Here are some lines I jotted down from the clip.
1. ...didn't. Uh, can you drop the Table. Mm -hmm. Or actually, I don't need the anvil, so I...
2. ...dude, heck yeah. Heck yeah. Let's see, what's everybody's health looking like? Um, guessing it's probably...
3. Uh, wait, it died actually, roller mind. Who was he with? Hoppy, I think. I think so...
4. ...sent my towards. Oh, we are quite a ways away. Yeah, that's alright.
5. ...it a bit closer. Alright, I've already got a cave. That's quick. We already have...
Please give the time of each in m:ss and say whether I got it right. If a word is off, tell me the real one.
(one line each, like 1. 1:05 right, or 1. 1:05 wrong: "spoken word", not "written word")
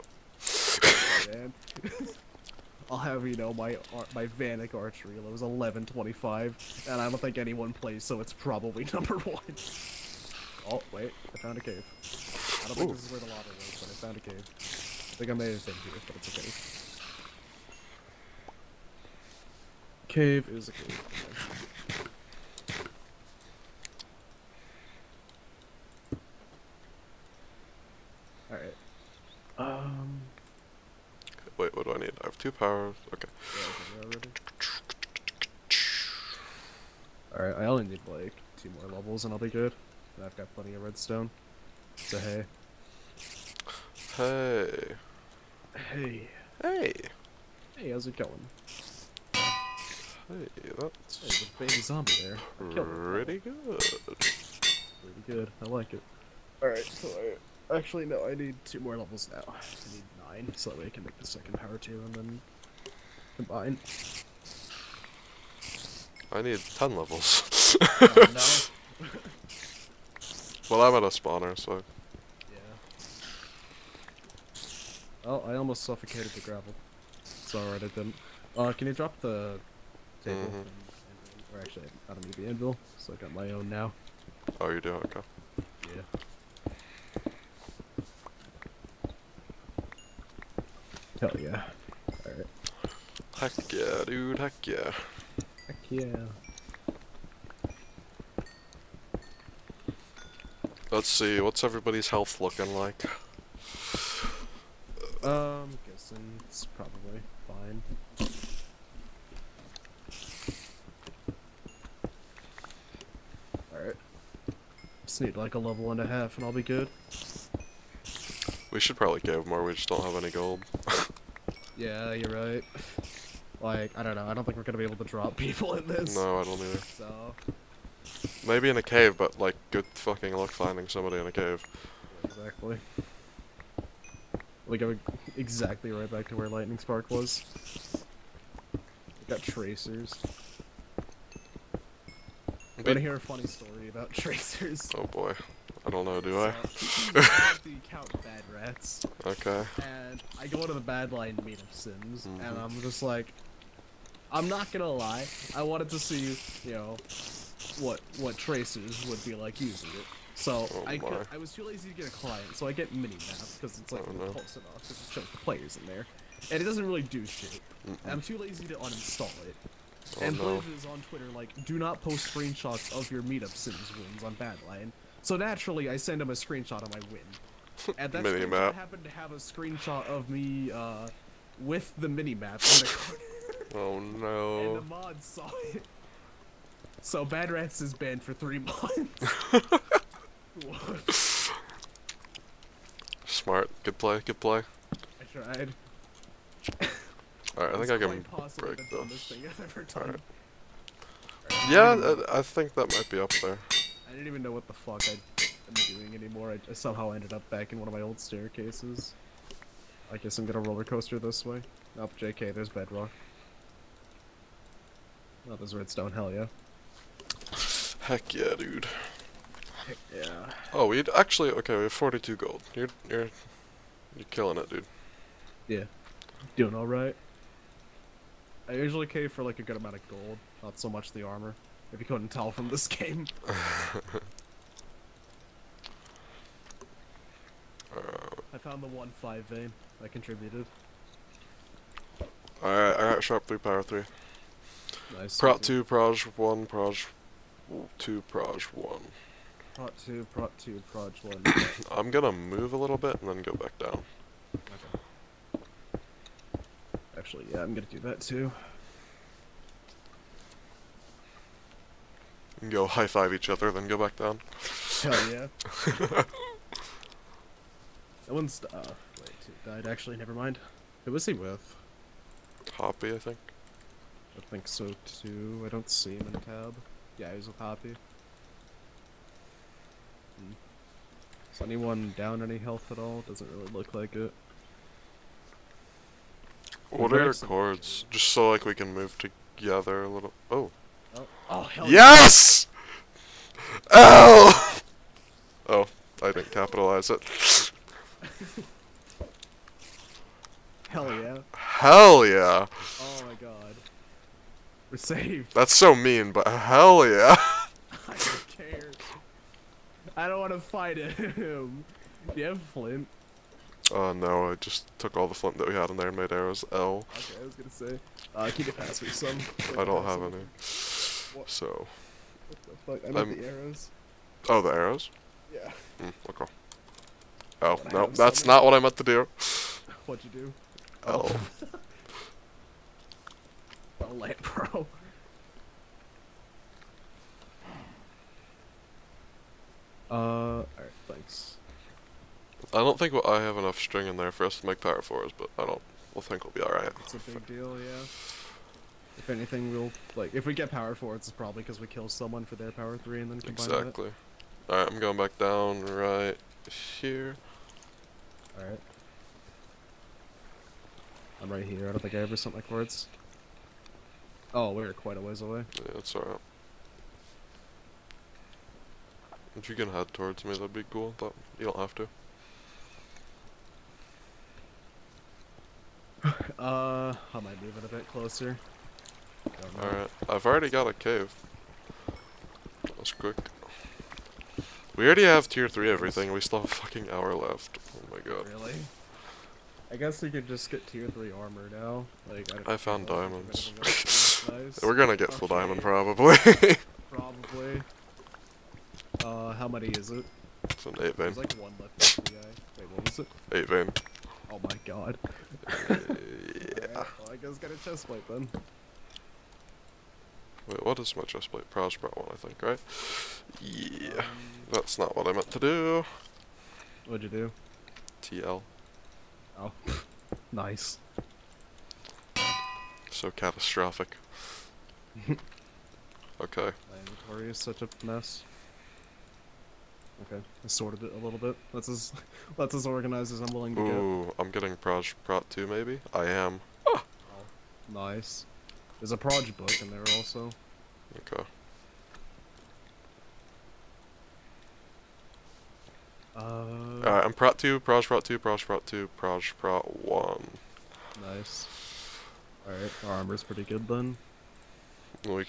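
1. 1:17 right
2. 1:34 right
3. 4:28 wrong: "never", not "roller"
4. 6:02 wrong: "cords", not "towards"
5. 6:17 right.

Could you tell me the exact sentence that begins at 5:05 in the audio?
That's so mean, but hell yeah.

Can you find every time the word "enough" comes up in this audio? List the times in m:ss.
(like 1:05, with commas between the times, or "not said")
2:44, 5:43.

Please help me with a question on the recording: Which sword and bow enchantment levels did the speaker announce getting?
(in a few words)
sharp 3 power 3.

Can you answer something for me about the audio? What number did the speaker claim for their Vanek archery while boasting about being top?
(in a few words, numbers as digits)
1125.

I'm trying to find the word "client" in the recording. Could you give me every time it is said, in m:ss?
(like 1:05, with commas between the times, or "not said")
2:42.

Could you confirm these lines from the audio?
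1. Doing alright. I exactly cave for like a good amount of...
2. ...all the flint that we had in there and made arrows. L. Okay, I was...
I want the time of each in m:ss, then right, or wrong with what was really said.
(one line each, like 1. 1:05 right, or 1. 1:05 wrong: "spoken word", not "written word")
1. 3:46 wrong: "usually", not "exactly"
2. 5:15 right.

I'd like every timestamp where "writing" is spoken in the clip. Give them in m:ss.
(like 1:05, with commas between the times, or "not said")
not said.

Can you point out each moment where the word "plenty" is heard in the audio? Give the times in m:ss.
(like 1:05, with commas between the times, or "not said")
0:40.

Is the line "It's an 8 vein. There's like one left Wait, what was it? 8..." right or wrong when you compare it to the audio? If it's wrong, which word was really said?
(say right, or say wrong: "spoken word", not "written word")
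right.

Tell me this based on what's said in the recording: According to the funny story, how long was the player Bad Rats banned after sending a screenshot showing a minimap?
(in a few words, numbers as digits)
3 months.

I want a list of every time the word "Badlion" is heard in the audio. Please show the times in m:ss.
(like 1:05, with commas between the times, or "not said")
2:30, 2:54.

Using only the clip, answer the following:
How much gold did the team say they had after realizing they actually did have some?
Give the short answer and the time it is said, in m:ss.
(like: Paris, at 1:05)
42, at 3:41.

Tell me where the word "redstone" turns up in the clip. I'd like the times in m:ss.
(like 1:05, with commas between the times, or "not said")
0:40, 3:35.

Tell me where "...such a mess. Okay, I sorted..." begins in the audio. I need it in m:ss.
7:07.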